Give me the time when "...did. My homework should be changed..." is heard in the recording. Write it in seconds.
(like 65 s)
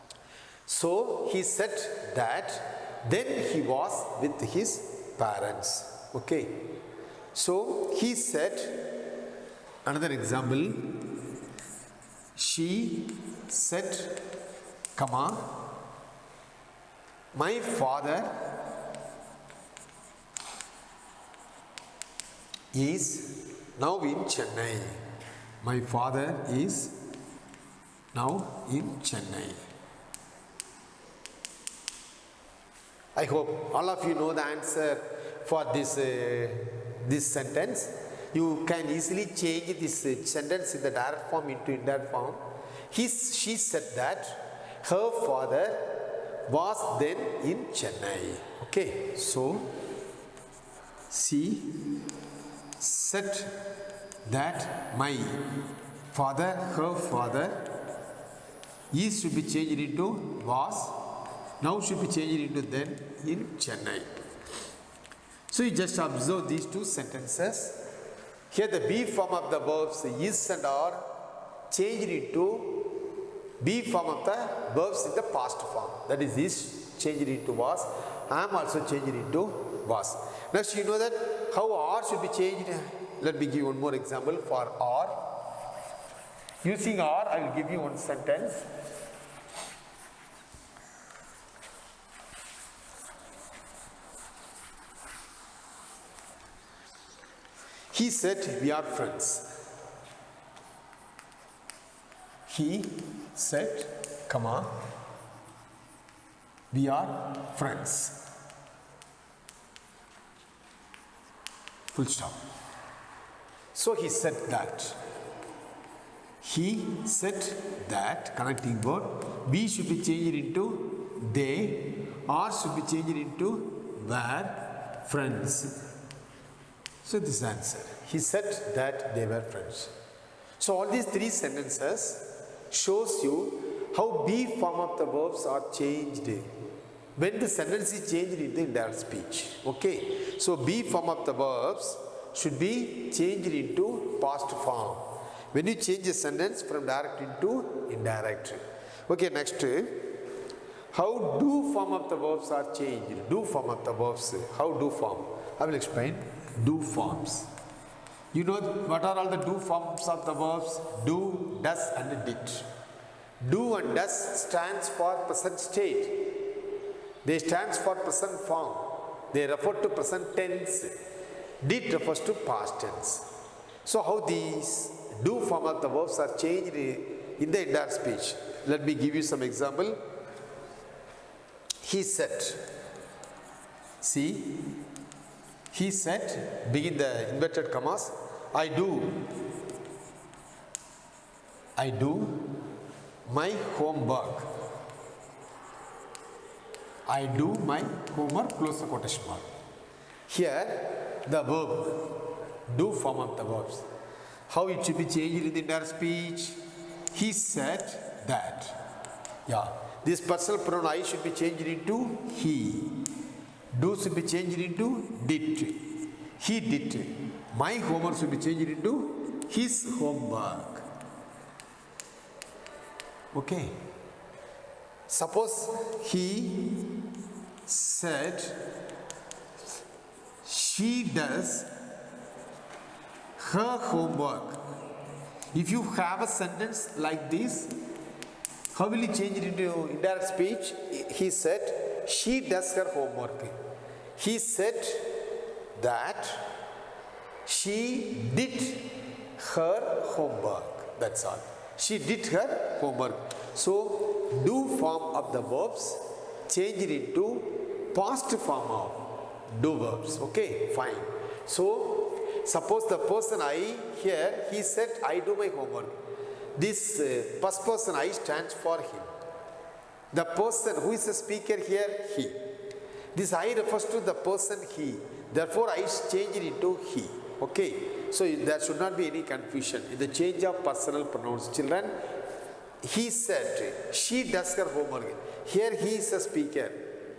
216 s.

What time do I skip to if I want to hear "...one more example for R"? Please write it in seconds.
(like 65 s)
83 s.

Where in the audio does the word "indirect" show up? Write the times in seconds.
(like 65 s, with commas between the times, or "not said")
41 s, 138 s, 147 s, 239 s.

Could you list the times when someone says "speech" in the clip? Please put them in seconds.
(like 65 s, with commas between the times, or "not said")
138 s, 177 s, 205 s, 240 s.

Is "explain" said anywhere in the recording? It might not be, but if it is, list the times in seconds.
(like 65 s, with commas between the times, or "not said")
155 s.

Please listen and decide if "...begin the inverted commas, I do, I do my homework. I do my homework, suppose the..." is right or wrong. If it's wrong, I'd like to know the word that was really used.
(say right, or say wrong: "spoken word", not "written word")
wrong: "close", not "suppose".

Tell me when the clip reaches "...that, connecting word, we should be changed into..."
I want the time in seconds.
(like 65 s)
117 s.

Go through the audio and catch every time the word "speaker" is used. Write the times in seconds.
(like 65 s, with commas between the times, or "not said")
271 s, 286 s.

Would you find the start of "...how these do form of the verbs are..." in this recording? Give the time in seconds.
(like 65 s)
174 s.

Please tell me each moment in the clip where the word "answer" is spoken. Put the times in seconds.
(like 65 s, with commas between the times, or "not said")
34 s, 127 s.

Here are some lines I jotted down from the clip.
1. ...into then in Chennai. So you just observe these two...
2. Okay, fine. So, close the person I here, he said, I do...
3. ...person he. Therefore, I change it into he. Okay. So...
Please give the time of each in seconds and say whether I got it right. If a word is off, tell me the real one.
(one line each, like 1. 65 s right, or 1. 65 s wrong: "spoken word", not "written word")
1. 62 s right
2. 260 s wrong: "suppose", not "close"
3. 274 s right.